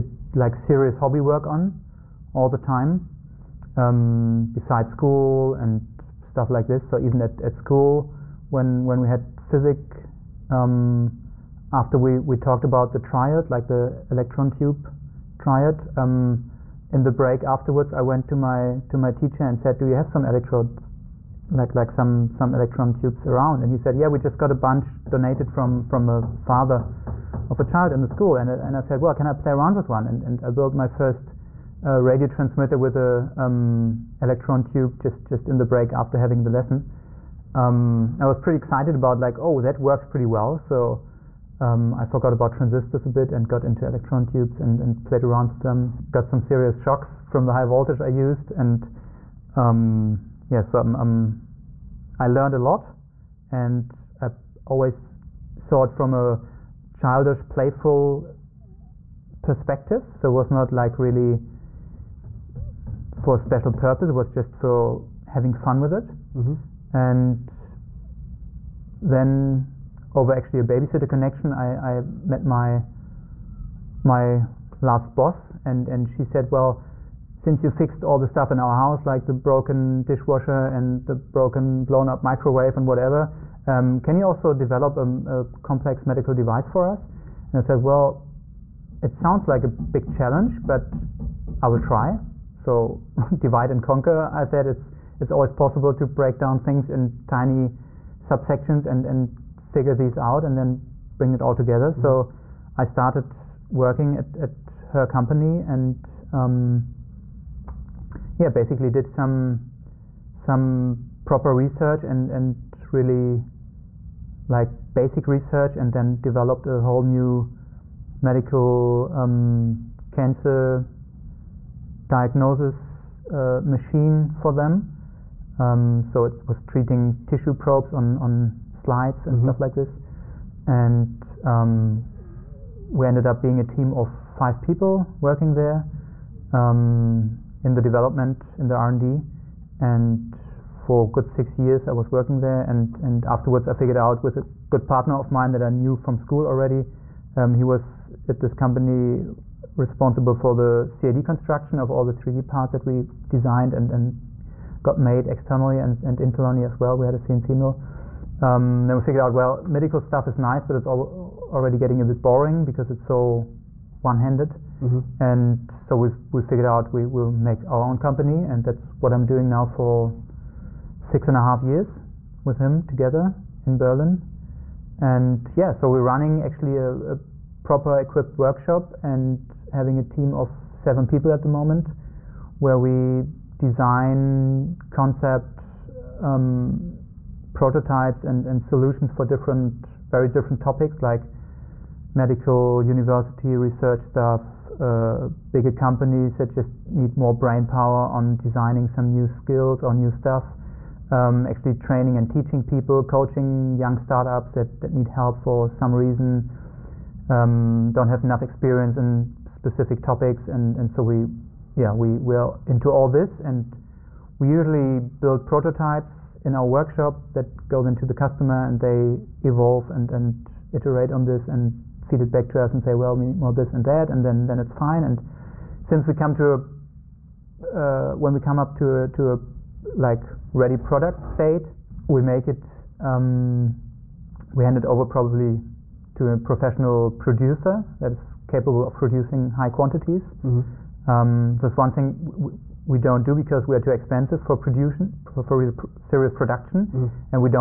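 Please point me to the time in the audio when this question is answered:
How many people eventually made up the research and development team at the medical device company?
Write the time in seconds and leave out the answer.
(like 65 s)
134 s.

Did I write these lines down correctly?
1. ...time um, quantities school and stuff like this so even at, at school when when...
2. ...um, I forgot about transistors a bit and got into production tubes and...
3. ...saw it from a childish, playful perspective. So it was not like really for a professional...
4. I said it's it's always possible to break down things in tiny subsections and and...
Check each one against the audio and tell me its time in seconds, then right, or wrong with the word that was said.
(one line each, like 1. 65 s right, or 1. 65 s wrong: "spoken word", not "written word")
1. 2 s wrong: "besides", not "quantities"
2. 41 s wrong: "electron", not "production"
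3. 55 s wrong: "special", not "professional"
4. 94 s right.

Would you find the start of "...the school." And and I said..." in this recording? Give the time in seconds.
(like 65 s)
28 s.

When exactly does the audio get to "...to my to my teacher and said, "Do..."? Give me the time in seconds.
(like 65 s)
18 s.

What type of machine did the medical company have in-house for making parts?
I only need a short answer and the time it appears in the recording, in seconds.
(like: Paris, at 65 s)
CNC mill, at 157 s.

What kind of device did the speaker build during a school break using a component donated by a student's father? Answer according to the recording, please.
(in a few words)
radio transmitter.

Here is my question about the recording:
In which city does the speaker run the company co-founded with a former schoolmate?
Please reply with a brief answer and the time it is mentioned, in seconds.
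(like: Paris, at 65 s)
Berlin, at 173 s.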